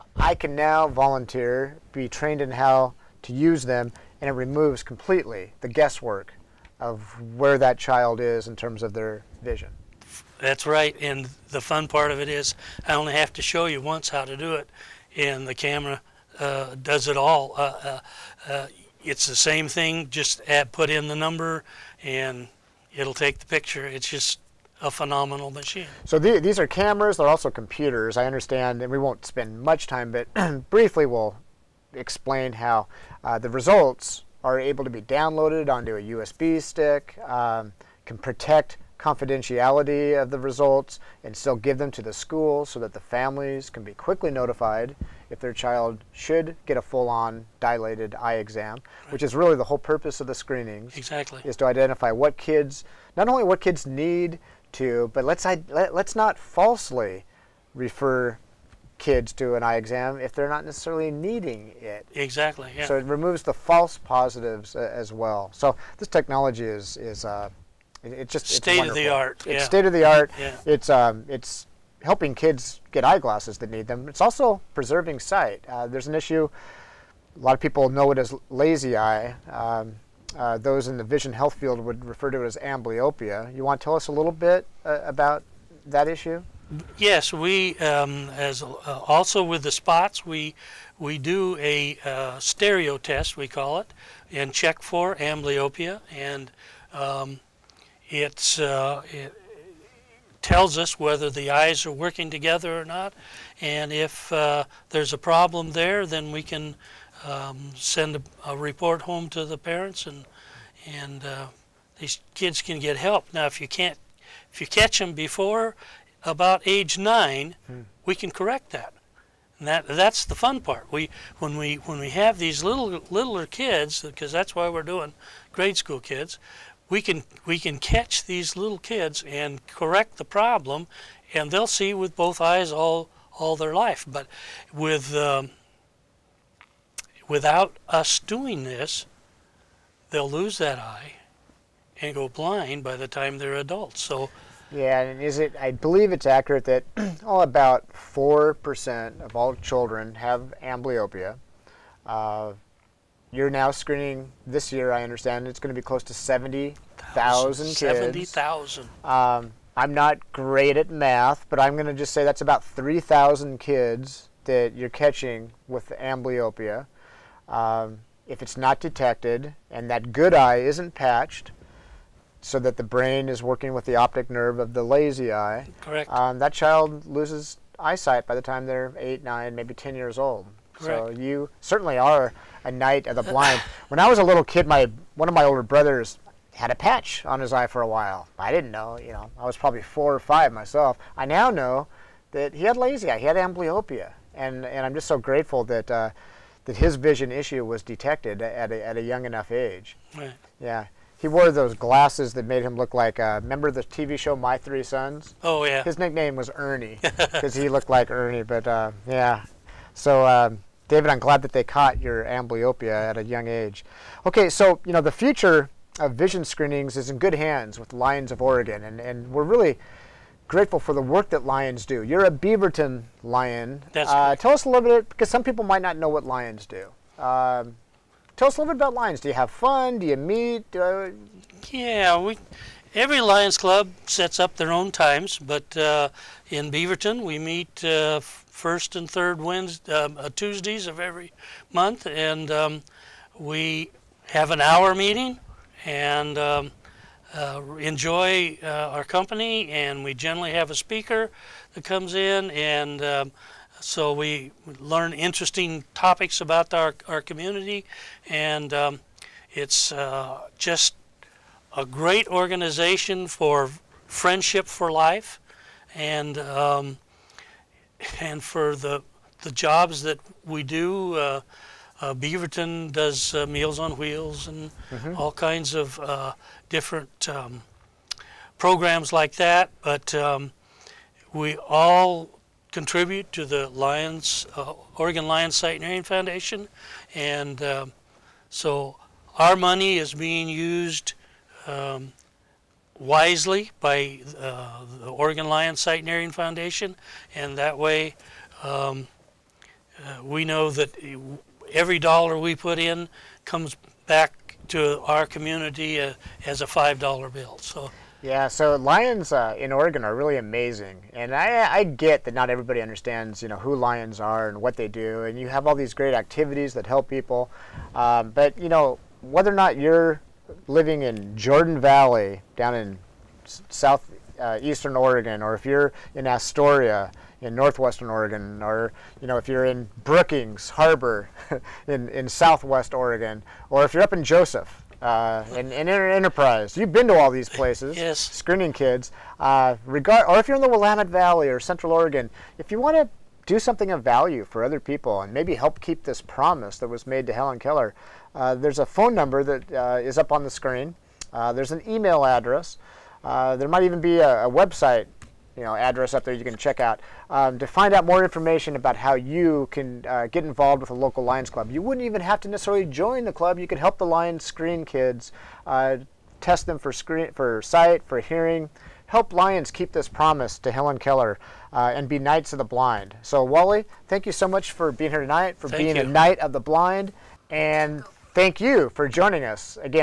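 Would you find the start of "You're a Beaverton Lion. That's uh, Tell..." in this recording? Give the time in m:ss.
3:42.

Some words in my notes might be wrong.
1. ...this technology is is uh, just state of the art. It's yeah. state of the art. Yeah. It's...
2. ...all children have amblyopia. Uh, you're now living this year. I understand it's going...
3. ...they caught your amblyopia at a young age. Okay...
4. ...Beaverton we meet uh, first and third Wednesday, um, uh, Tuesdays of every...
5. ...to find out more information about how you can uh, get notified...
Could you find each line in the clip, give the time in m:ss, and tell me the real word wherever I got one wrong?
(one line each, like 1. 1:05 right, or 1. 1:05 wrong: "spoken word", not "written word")
1. 1:05 right
2. 2:29 wrong: "screening", not "living"
3. 3:31 right
4. 3:56 right
5. 5:57 wrong: "involved", not "notified".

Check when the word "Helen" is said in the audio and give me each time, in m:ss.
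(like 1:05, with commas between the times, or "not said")
5:47, 6:10.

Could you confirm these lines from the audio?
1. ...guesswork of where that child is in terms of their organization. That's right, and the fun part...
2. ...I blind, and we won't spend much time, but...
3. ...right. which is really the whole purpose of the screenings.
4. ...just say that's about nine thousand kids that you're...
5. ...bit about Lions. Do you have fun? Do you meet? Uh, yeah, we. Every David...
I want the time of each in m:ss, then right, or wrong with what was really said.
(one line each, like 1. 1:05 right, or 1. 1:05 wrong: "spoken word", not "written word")
1. 0:05 wrong: "vision", not "organization"
2. 0:28 wrong: "understand", not "blind"
3. 0:49 right
4. 2:41 wrong: "three", not "nine"
5. 3:48 wrong: "Lions", not "David".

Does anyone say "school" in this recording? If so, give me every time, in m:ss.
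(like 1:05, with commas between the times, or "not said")
0:42, 2:05.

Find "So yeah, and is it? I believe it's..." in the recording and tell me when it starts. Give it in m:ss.
2:24.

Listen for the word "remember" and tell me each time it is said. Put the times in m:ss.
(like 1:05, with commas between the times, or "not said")
3:23.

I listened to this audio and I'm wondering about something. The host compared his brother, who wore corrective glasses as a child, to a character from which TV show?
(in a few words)
My Three Sons.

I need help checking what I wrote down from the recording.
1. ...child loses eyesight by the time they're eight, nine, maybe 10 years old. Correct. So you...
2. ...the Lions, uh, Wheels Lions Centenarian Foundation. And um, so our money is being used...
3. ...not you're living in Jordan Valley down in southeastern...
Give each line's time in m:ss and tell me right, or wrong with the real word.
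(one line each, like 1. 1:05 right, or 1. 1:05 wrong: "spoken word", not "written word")
1. 2:56 right
2. 4:43 wrong: "Oregon", not "Wheels"
3. 5:19 right.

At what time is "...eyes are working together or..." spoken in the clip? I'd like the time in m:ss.
1:41.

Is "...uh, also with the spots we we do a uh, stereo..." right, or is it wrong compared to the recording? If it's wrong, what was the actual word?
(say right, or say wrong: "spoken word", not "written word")
right.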